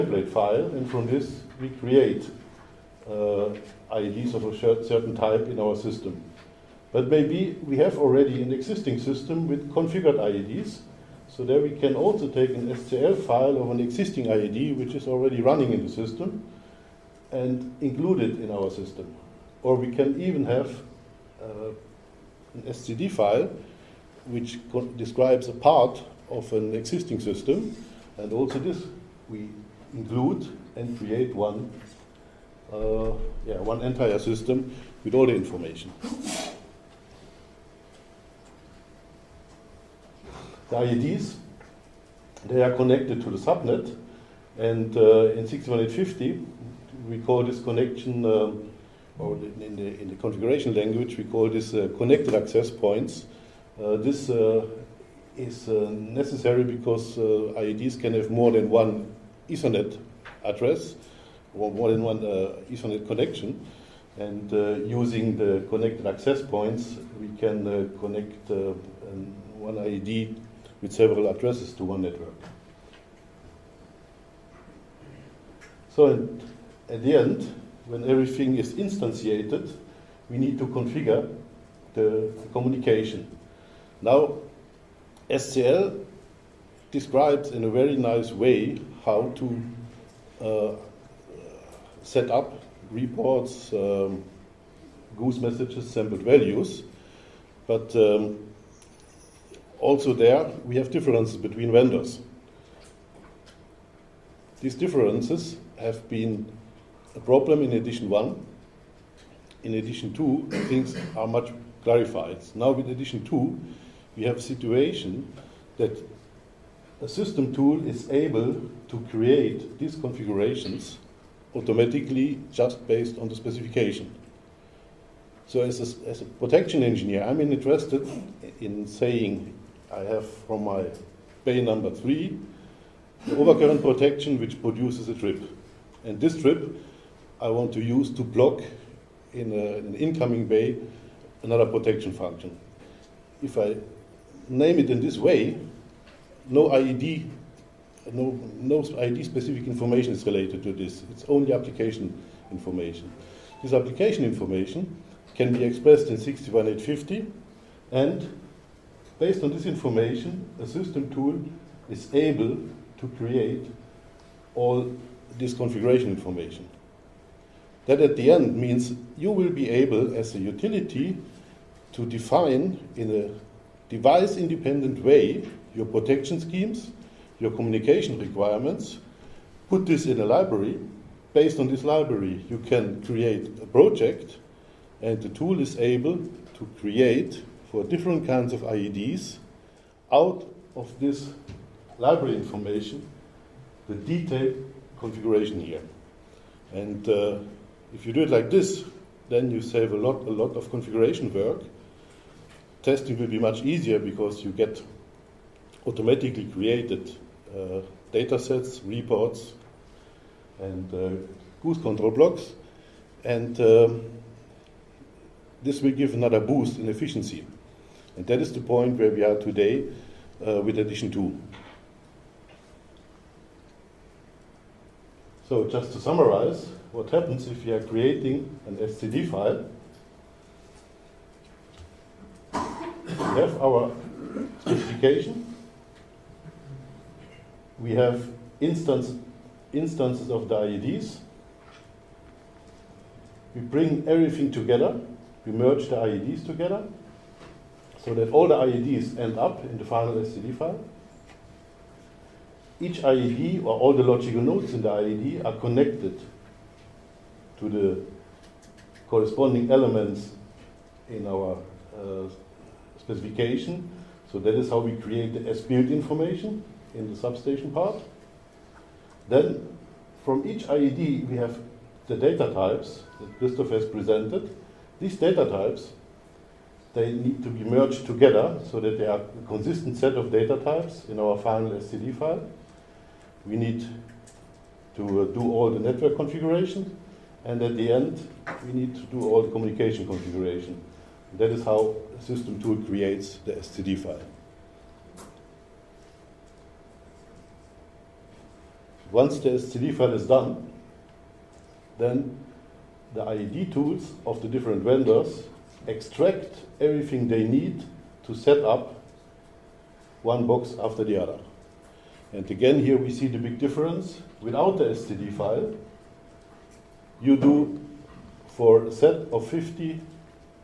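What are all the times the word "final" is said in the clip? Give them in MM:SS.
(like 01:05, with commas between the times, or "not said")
04:09, 04:41.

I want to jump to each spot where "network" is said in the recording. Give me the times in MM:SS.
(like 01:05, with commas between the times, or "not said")
01:12, 04:45.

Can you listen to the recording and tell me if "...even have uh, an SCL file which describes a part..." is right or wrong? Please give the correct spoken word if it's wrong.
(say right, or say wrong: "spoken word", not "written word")
wrong: "SCD", not "SCL".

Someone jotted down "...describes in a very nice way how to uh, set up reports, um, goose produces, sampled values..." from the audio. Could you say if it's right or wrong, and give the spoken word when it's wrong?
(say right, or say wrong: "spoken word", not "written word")
wrong: "messages", not "produces".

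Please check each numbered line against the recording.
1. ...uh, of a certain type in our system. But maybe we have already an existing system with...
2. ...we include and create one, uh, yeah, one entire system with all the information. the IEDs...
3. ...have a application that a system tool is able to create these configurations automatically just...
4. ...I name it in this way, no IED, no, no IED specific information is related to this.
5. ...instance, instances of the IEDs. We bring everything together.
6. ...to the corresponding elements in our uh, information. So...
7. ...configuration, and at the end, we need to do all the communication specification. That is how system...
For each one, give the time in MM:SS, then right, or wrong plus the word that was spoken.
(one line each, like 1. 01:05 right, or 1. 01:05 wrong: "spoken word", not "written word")
1. 00:03 right
2. 00:29 right
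3. 01:54 wrong: "situation", not "application"
4. 02:23 right
5. 03:58 right
6. 04:17 wrong: "specification", not "information"
7. 04:46 wrong: "configuration", not "specification".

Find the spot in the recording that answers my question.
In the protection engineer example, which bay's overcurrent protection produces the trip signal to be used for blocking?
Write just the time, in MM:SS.
02:11.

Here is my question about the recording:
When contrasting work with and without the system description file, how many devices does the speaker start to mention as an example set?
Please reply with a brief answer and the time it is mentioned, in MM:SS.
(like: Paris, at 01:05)
50, at 05:19.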